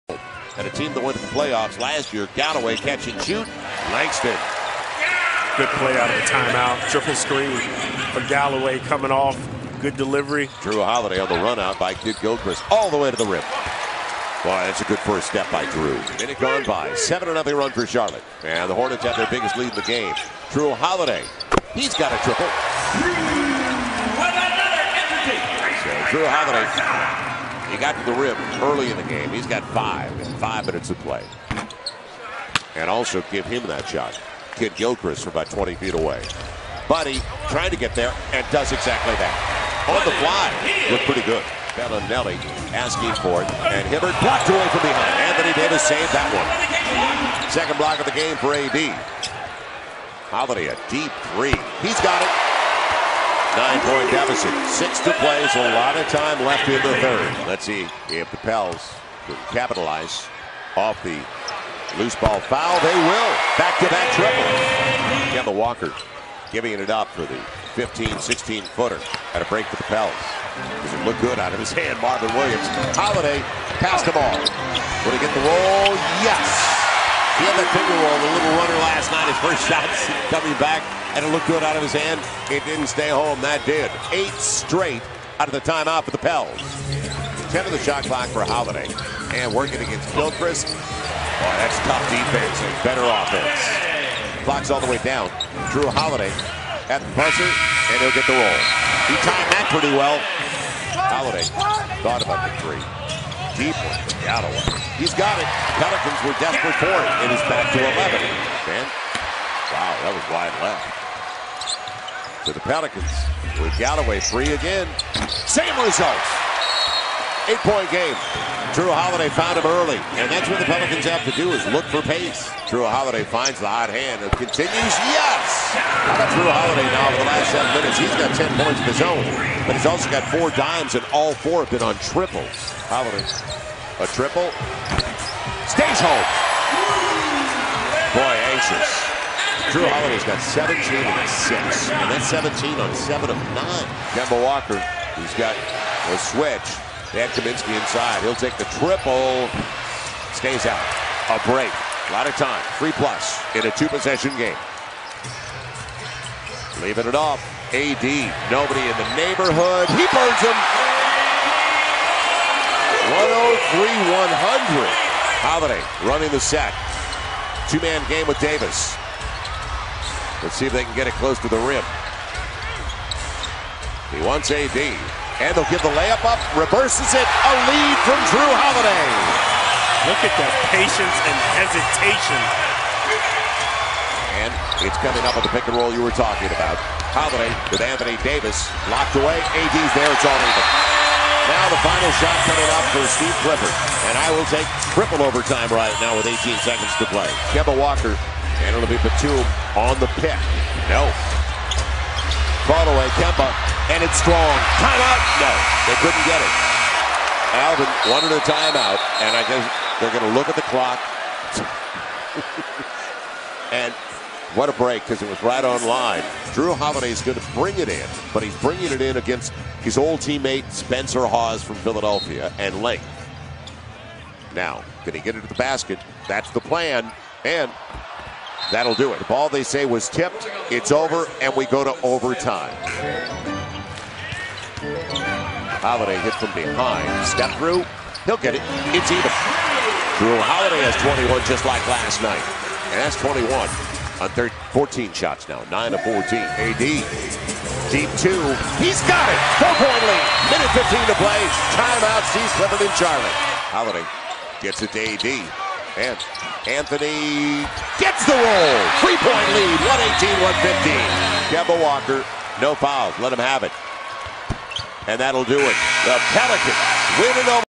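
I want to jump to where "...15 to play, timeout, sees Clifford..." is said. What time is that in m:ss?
4:10.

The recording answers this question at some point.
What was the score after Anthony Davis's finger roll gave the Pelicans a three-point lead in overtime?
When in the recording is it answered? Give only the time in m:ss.
4:21.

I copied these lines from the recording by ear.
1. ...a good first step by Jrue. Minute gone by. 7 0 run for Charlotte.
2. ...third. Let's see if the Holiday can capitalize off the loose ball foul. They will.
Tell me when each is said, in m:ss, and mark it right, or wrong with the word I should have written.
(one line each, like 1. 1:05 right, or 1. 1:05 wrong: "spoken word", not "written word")
1. 0:14 right
2. 0:57 wrong: "Pels", not "Holiday".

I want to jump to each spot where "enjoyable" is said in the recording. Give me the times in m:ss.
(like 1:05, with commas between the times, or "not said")
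not said.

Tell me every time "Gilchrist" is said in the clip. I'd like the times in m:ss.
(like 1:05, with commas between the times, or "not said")
0:11, 0:34, 1:30.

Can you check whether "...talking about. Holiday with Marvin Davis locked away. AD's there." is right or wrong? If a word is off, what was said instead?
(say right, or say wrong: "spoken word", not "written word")
wrong: "Anthony", not "Marvin".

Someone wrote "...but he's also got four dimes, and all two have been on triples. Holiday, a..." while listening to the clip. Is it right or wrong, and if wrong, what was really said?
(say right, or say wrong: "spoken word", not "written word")
wrong: "four", not "two".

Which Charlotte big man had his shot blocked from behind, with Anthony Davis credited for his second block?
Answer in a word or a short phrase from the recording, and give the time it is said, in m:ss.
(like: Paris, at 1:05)
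Hibbert, at 0:43.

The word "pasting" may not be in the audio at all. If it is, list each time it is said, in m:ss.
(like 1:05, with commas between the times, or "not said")
not said.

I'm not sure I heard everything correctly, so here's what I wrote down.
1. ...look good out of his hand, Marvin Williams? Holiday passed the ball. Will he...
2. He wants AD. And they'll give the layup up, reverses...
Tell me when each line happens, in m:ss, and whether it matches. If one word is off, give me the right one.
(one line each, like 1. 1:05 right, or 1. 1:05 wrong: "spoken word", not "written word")
1. 1:11 right
2. 2:54 right.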